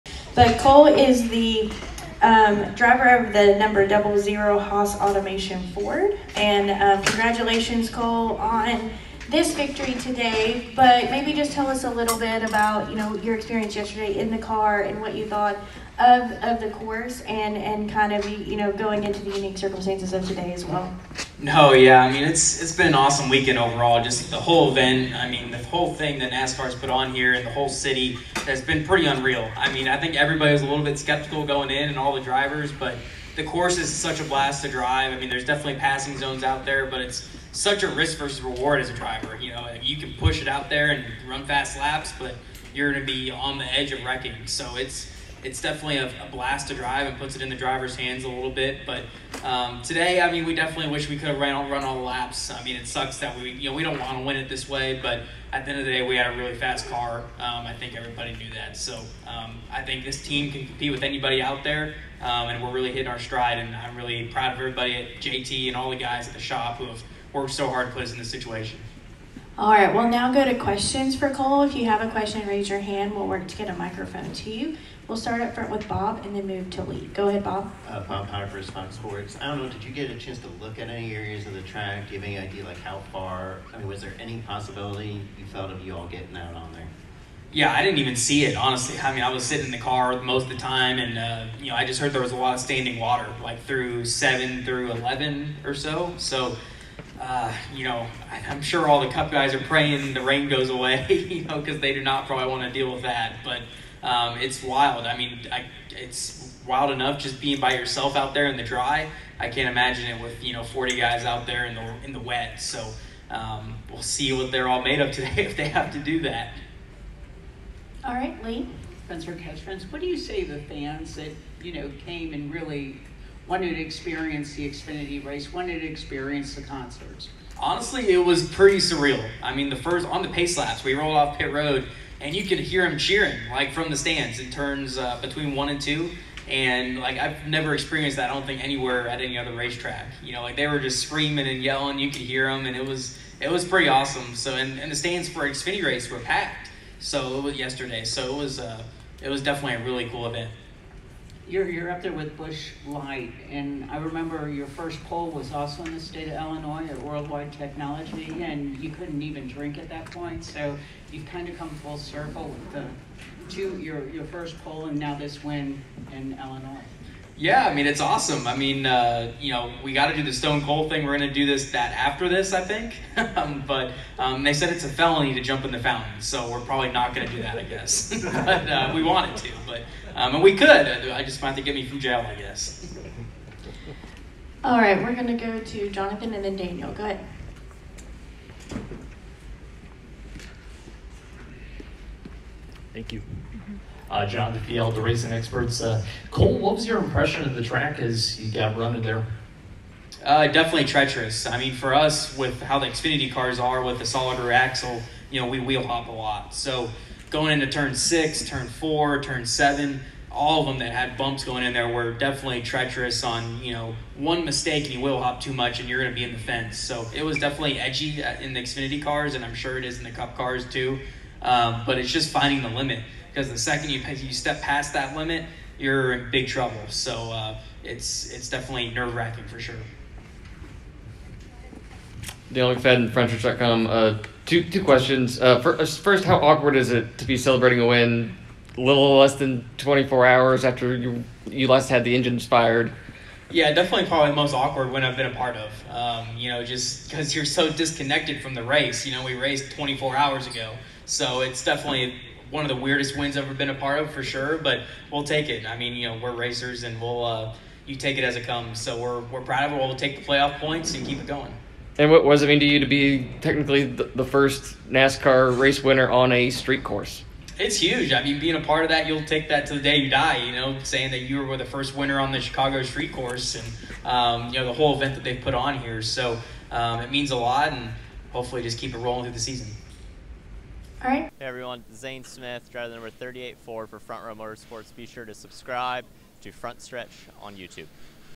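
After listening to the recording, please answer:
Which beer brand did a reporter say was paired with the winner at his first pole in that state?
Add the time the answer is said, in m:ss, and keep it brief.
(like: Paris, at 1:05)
Busch Light, at 2:32.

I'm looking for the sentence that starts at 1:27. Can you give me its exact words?
Yeah, I didn't even see it, honestly.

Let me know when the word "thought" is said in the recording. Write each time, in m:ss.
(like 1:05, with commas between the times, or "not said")
0:15.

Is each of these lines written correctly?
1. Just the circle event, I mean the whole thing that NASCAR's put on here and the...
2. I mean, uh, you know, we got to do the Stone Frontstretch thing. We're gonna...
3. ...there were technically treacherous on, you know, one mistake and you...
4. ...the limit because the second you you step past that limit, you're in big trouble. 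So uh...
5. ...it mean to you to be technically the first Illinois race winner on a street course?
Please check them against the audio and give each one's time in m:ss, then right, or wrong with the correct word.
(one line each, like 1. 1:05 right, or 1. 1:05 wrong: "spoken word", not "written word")
1. 0:24 wrong: "whole", not "circle"
2. 2:48 wrong: "Cold", not "Frontstretch"
3. 3:31 wrong: "definitely", not "technically"
4. 3:42 right
5. 4:22 wrong: "NASCAR", not "Illinois".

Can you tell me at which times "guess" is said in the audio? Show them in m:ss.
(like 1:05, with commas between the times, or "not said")
2:57, 3:02.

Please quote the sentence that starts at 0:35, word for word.
I mean there's definitely passing zones out there, but it's such a risk versus reward as a driver.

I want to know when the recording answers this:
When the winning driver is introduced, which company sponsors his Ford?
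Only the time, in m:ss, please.
0:04.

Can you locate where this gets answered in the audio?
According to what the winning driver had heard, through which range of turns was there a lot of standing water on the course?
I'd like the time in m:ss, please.
1:34.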